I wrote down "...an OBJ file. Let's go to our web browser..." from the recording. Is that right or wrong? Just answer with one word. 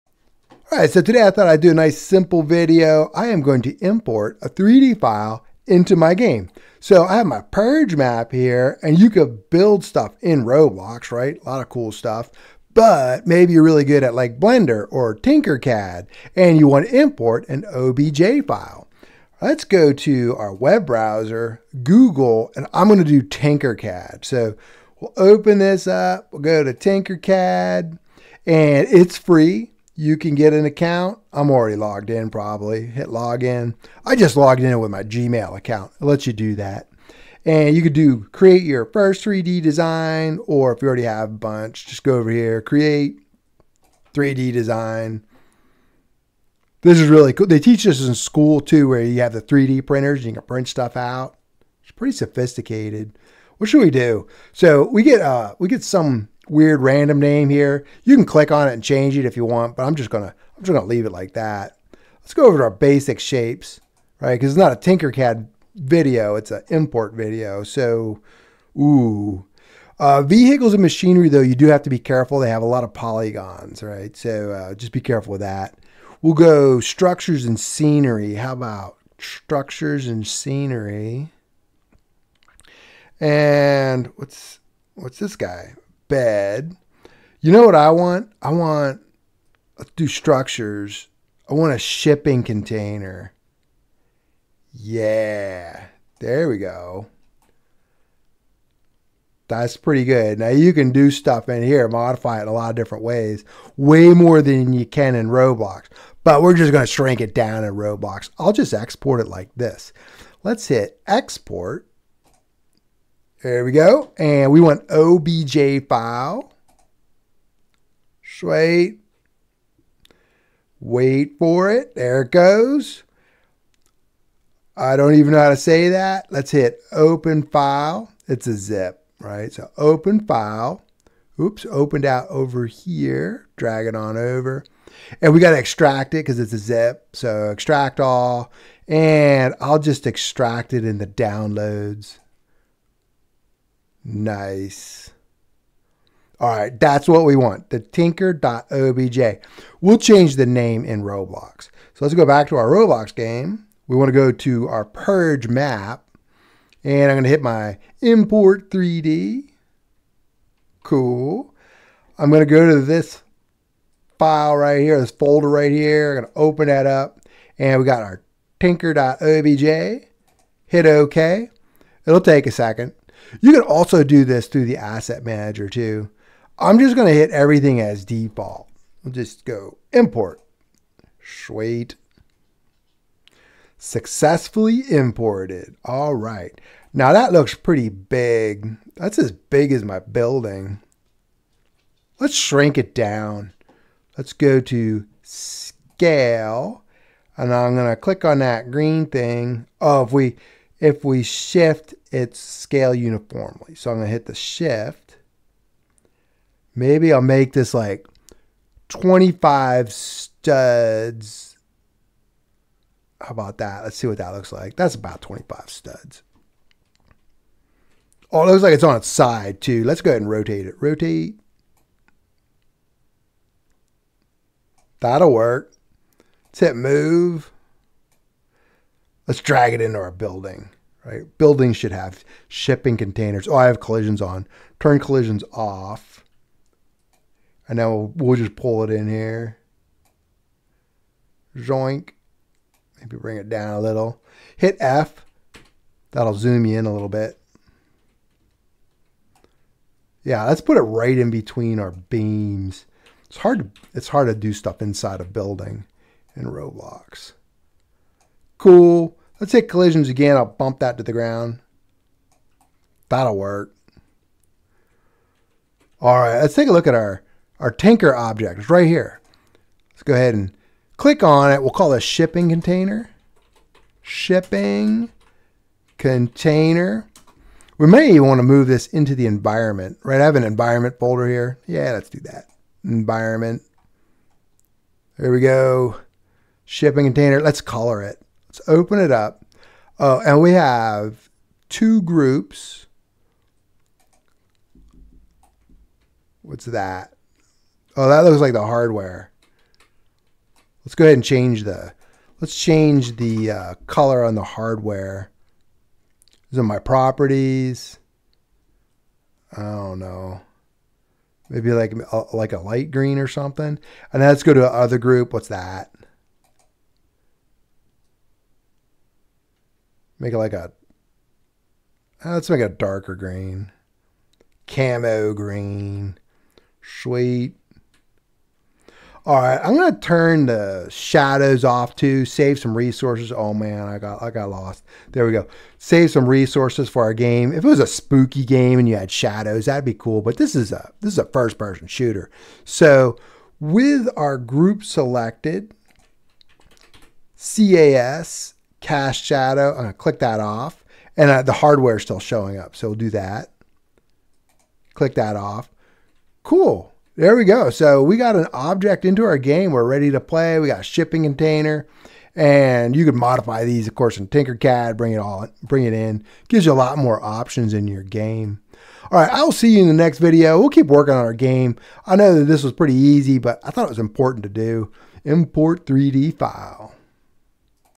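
right.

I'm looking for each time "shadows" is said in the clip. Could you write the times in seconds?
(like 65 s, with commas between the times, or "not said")
330 s, 339 s, 349 s.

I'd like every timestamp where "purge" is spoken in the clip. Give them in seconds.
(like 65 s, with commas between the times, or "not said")
7 s, 154 s.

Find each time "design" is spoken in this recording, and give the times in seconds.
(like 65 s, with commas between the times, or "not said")
39 s, 44 s.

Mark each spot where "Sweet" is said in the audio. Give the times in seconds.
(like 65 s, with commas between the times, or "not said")
118 s, 181 s, 327 s.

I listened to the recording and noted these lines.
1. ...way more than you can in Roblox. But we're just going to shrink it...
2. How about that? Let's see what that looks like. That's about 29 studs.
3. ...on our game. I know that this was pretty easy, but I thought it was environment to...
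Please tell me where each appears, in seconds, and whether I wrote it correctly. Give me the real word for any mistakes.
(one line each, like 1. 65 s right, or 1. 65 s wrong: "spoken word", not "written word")
1. 103 s right
2. 213 s wrong: "25", not "29"
3. 371 s wrong: "important", not "environment".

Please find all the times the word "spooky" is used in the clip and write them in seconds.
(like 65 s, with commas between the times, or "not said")
337 s.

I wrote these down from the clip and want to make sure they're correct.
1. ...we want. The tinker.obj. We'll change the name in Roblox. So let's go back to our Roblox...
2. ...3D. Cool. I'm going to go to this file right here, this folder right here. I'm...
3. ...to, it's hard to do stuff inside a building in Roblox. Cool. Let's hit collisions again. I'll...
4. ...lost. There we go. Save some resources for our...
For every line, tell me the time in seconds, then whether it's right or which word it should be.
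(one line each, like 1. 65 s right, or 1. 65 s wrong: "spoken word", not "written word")
1. 147 s right
2. 158 s right
3. 253 s right
4. 334 s right.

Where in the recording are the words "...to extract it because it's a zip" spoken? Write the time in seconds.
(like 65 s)
135 s.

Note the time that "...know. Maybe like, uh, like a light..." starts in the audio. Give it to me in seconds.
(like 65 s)
309 s.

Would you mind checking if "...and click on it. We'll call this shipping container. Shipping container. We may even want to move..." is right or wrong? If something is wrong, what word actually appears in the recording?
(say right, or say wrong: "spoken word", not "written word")
right.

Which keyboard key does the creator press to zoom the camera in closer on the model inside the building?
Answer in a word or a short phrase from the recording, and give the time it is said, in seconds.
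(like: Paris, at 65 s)
F, at 244 s.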